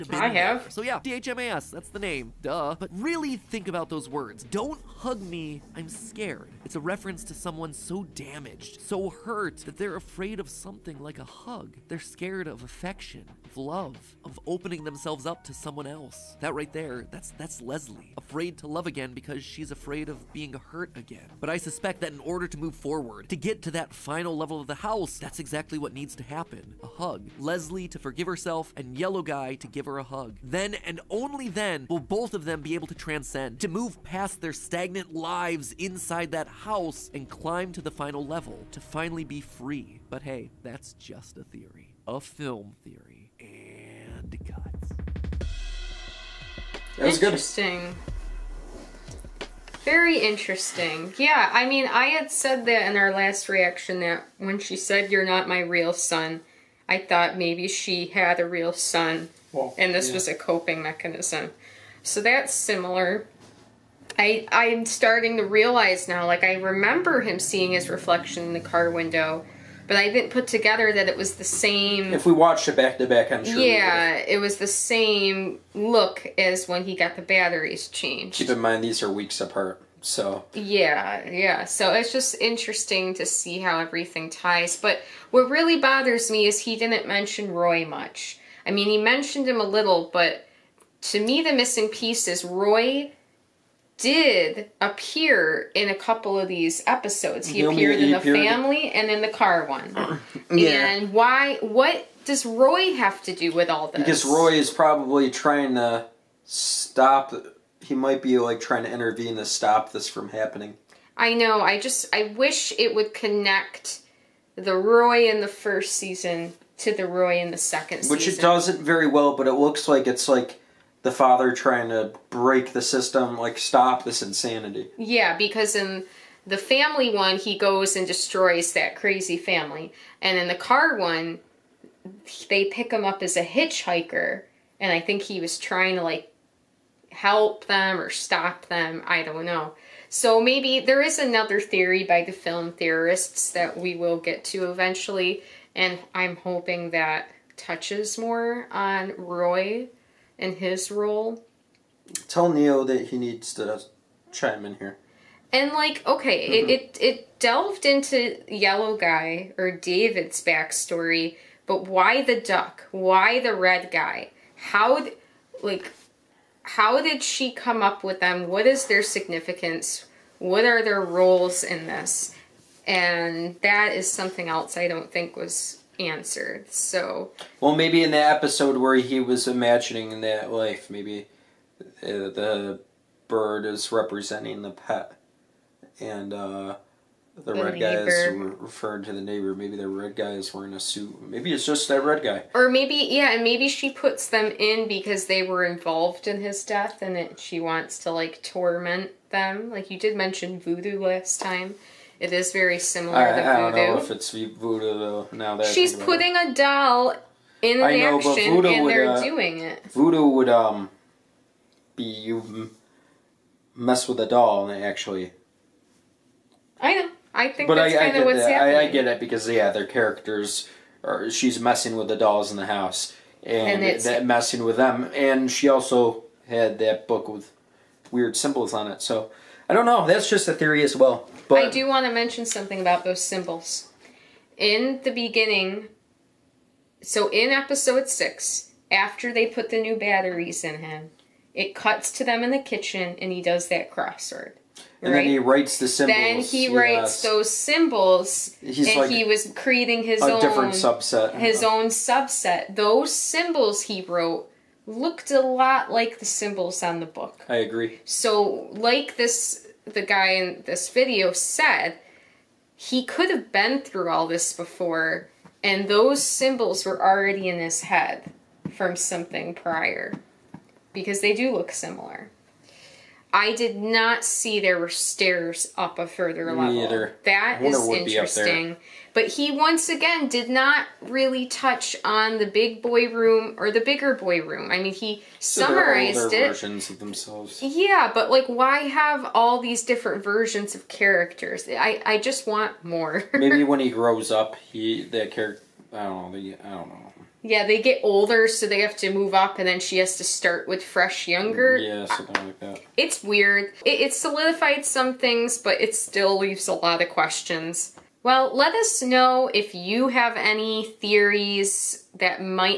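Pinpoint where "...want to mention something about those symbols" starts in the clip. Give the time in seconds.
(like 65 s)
231 s.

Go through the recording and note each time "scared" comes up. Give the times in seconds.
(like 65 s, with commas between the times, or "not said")
5 s, 11 s.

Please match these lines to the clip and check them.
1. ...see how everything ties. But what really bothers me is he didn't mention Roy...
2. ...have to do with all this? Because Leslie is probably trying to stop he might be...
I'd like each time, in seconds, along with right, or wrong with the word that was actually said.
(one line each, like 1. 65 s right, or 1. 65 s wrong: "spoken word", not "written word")
1. 83 s right
2. 102 s wrong: "Roy", not "Leslie".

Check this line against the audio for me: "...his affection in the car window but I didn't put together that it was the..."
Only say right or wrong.
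wrong.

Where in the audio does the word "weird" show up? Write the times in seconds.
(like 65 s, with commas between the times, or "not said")
228 s, 303 s.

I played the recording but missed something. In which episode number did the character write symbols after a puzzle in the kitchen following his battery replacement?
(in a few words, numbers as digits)
6.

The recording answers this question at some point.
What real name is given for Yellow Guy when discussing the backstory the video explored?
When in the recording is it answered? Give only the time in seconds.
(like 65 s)
159 s.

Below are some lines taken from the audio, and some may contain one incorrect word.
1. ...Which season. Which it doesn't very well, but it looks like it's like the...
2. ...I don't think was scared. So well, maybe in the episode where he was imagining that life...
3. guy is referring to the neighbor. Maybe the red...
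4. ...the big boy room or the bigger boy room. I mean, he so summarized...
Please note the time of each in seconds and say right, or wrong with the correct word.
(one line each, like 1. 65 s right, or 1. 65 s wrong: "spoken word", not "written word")
1. 117 s right
2. 174 s wrong: "answered", not "scared"
3. 188 s right
4. 282 s right.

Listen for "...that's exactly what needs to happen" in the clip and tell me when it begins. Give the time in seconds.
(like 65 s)
25 s.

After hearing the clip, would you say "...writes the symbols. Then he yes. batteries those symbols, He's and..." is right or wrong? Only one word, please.
wrong.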